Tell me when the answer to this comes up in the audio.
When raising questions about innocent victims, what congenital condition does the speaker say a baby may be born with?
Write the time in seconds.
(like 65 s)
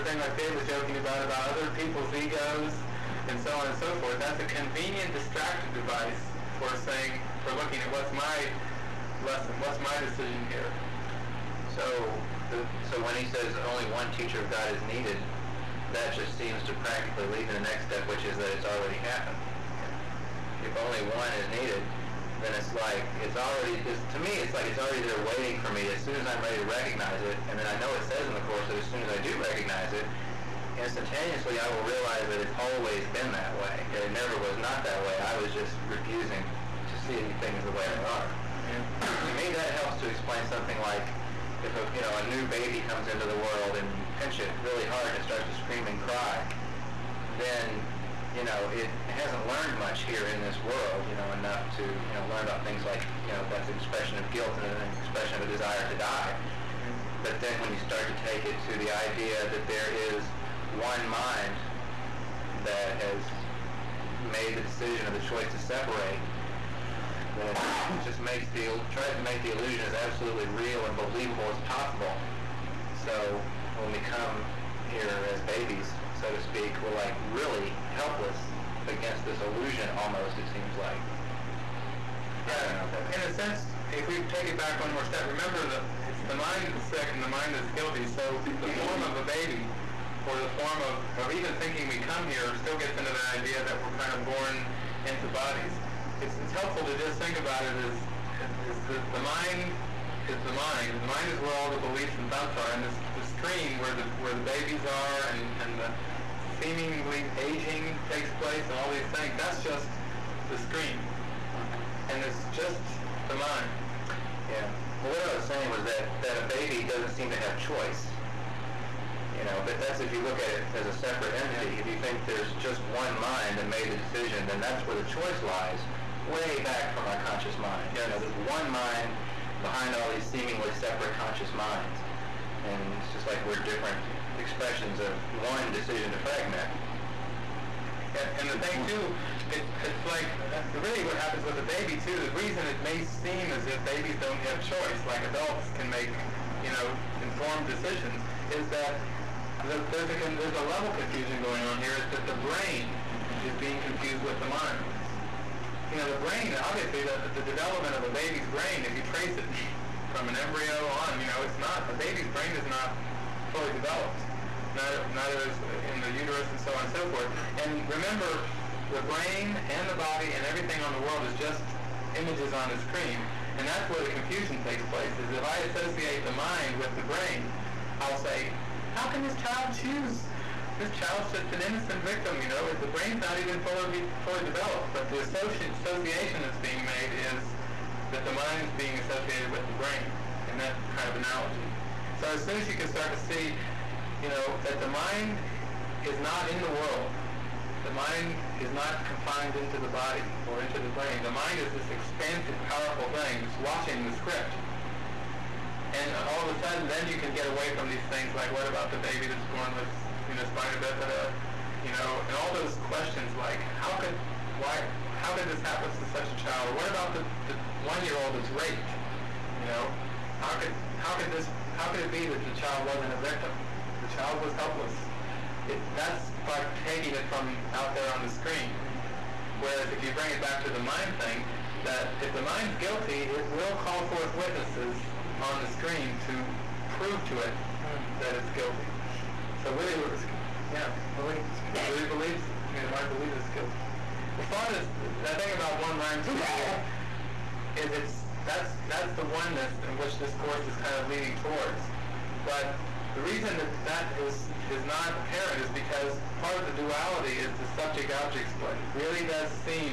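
210 s.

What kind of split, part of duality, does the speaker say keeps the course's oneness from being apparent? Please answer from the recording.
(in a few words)
subject-object split.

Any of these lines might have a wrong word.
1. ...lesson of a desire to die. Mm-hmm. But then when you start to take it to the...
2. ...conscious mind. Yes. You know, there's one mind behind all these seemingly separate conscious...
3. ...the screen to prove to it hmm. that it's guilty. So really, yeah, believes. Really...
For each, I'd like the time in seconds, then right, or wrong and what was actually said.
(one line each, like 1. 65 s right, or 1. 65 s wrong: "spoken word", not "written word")
1. 55 s wrong: "expression", not "lesson"
2. 127 s right
3. 235 s right.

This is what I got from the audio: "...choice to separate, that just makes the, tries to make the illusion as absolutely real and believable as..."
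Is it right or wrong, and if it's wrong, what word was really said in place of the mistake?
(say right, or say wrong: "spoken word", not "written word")
right.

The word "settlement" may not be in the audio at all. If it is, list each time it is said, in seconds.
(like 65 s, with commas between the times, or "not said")
not said.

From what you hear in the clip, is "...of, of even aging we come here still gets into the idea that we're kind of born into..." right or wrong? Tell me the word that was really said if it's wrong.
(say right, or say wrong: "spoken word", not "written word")
wrong: "thinking", not "aging".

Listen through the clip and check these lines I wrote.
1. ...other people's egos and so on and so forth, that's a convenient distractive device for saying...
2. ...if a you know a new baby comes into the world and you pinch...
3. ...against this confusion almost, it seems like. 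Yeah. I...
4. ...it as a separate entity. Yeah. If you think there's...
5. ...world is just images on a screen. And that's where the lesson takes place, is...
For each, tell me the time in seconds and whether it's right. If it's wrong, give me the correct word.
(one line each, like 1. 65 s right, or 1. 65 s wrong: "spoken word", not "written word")
1. 1 s right
2. 41 s right
3. 78 s wrong: "illusion", not "confusion"
4. 120 s right
5. 171 s wrong: "confusion", not "lesson".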